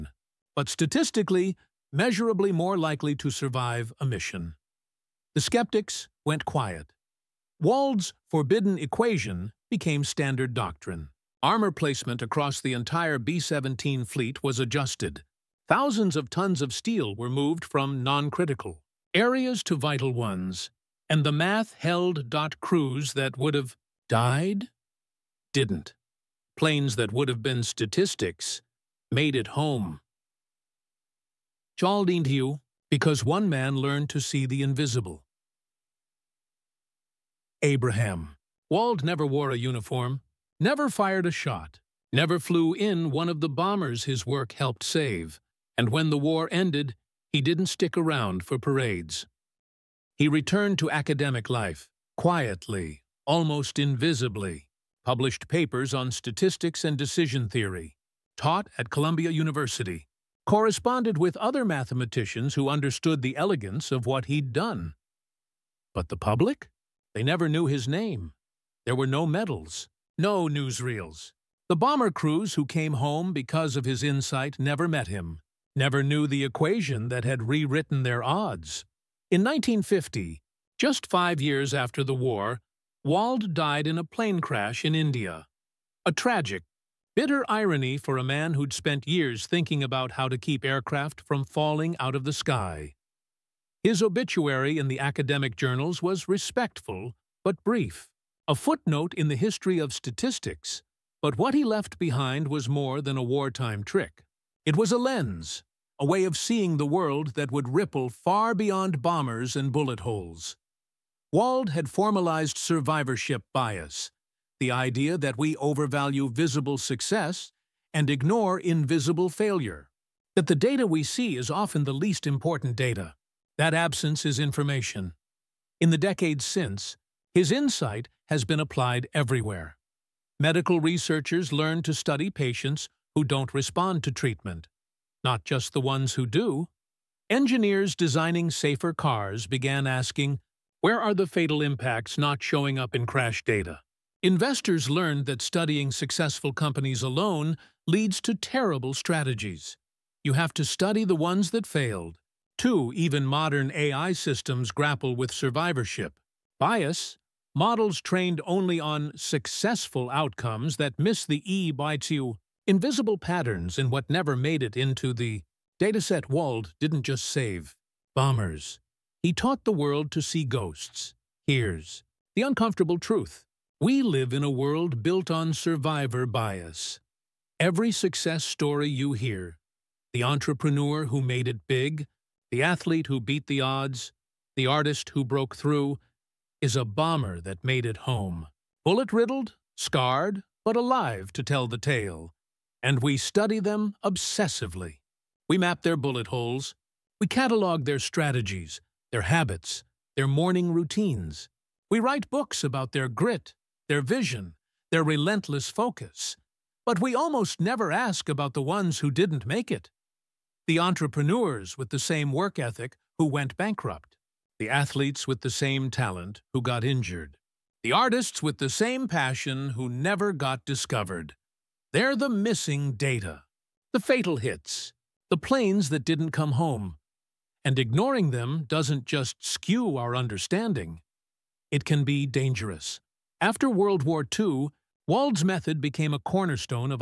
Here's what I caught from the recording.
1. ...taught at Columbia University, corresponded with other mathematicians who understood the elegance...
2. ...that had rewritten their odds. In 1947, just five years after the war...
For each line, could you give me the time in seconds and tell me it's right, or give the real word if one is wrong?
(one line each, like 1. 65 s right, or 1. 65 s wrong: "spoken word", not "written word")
1. 58 s right
2. 77 s wrong: "1950", not "1947".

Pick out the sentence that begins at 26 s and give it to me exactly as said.
Planes that would have been statistics made it home.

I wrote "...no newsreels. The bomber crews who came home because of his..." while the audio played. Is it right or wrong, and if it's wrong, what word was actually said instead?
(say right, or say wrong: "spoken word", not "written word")
right.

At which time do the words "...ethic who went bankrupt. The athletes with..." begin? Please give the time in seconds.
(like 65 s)
212 s.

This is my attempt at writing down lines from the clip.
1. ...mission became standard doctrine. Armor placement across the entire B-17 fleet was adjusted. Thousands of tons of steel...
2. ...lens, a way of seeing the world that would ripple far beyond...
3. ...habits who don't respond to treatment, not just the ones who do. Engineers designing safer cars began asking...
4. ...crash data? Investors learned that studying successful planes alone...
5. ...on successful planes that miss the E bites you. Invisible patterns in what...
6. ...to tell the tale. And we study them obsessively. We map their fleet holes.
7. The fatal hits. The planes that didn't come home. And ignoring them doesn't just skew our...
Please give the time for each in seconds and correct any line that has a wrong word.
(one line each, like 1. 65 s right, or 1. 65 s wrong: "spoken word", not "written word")
1. 8 s wrong: "equation", not "mission"
2. 104 s right
3. 132 s wrong: "patients", not "habits"
4. 143 s wrong: "companies", not "planes"
5. 158 s wrong: "outcomes", not "planes"
6. 191 s wrong: "bullet", not "fleet"
7. 223 s right.